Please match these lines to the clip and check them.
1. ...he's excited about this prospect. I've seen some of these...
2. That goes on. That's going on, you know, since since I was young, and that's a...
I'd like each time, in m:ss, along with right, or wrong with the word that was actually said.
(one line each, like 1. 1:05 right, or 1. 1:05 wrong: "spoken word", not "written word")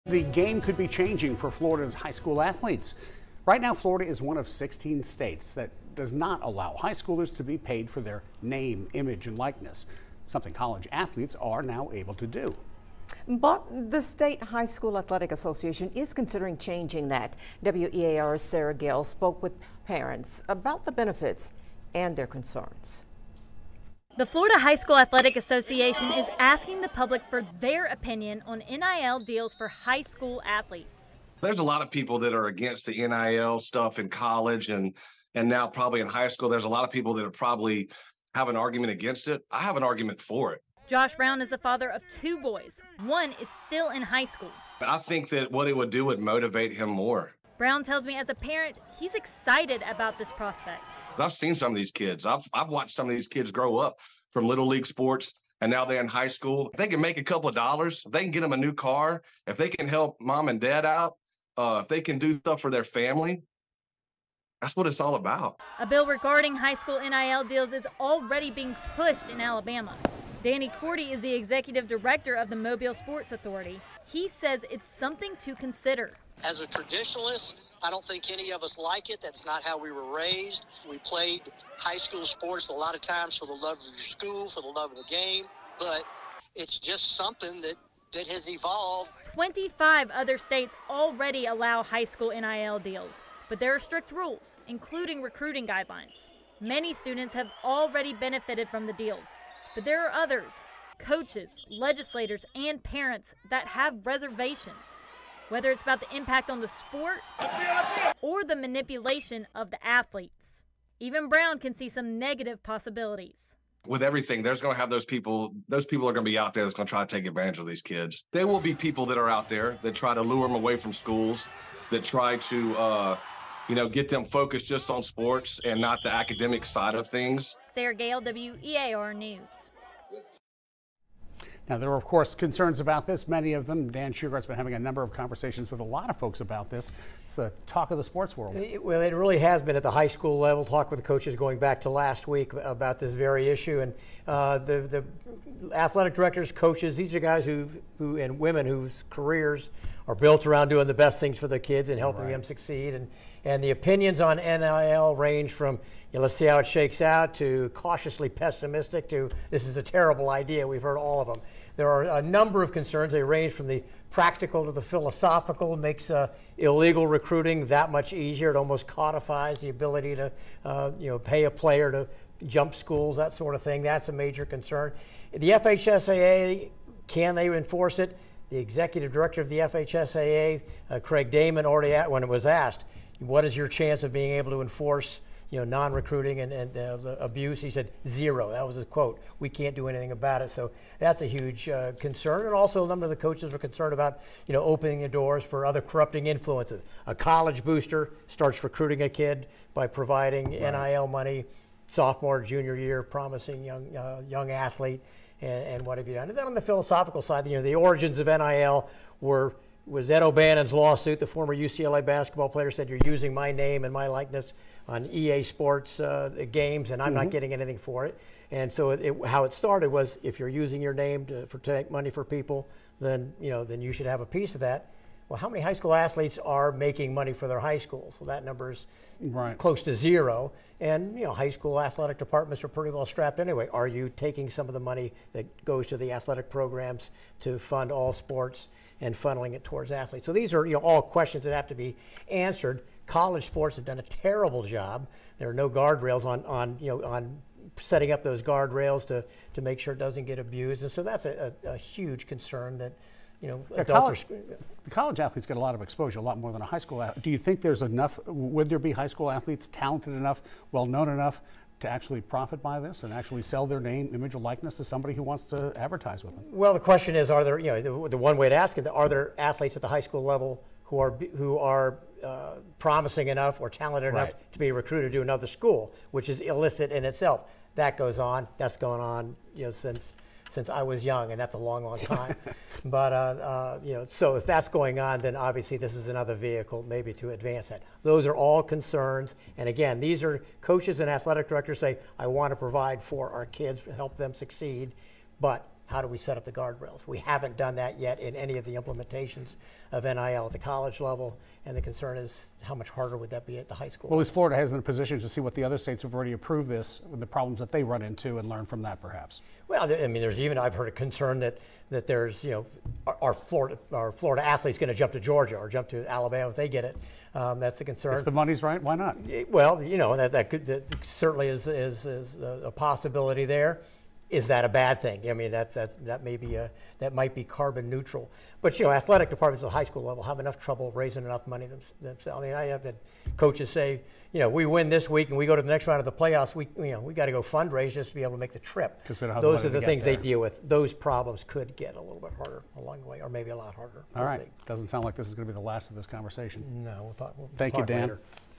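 1. 0:48 right
2. 4:37 right.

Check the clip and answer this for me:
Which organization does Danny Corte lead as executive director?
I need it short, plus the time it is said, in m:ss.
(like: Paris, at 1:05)
Mobile Sports Authority, at 1:12.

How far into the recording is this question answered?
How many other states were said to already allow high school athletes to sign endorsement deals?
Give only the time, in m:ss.
1:29.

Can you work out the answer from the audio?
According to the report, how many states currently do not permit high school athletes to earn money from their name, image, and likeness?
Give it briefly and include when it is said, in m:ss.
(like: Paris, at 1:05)
16, at 0:04.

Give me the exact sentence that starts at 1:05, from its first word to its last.
A bill regarding high school NIL deals is already being pushed in Alabama.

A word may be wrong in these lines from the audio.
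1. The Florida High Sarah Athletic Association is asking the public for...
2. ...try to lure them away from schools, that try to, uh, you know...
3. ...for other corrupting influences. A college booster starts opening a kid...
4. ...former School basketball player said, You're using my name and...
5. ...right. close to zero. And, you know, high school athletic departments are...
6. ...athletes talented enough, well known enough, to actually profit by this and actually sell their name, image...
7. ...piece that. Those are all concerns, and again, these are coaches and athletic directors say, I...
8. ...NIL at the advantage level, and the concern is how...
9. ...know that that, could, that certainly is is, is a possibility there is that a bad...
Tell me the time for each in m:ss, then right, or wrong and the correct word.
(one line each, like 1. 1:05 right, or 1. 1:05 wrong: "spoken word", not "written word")
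1. 0:24 wrong: "School", not "Sarah"
2. 1:59 right
3. 3:15 wrong: "recruiting", not "opening"
4. 3:31 wrong: "UCLA", not "School"
5. 3:49 right
6. 4:19 right
7. 4:47 wrong: "advance", not "piece"
8. 5:00 wrong: "college", not "advantage"
9. 5:19 right.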